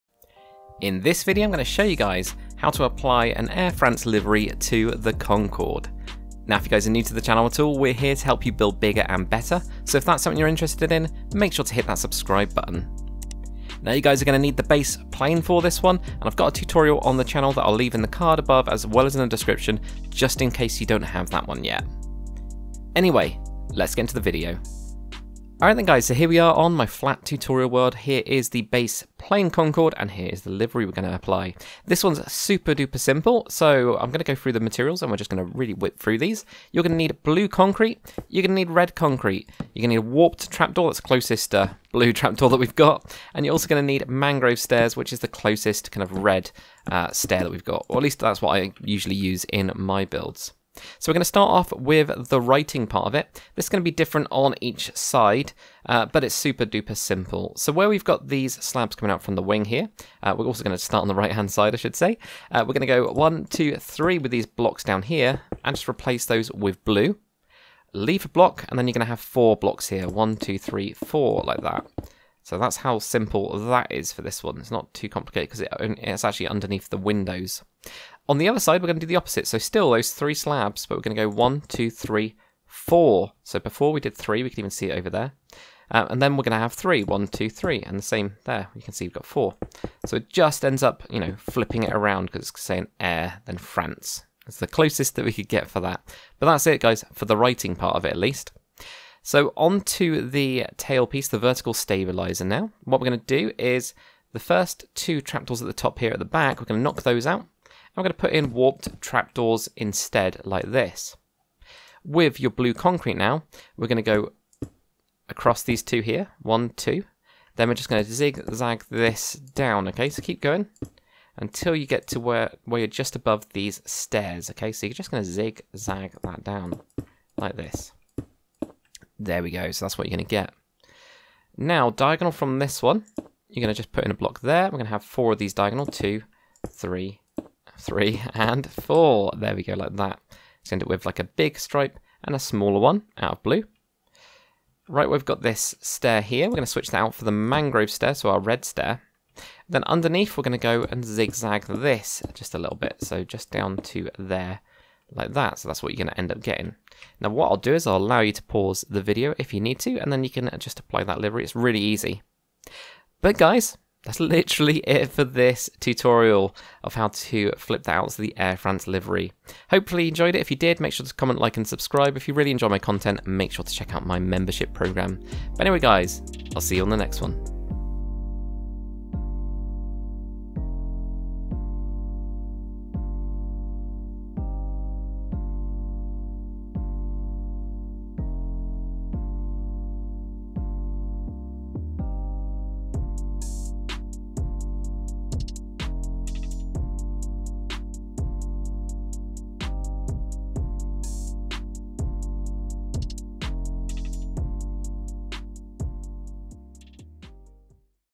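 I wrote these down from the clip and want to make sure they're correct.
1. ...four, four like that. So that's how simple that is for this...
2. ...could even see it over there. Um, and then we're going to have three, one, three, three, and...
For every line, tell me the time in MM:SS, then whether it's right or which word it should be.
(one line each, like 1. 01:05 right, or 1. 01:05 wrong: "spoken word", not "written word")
1. 01:10 wrong: "three", not "four"
2. 01:24 wrong: "two", not "three".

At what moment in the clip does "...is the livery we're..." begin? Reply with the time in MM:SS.
00:30.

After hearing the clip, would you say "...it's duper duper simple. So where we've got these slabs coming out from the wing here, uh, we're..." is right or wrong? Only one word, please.
wrong.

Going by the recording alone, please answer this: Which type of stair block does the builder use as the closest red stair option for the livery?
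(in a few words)
Mangrove stairs.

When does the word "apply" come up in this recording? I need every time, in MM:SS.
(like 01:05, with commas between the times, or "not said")
00:02, 00:31, 02:40.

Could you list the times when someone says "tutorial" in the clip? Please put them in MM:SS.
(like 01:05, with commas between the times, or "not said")
00:16, 00:27, 02:45.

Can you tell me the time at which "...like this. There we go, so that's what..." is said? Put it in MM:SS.
02:07.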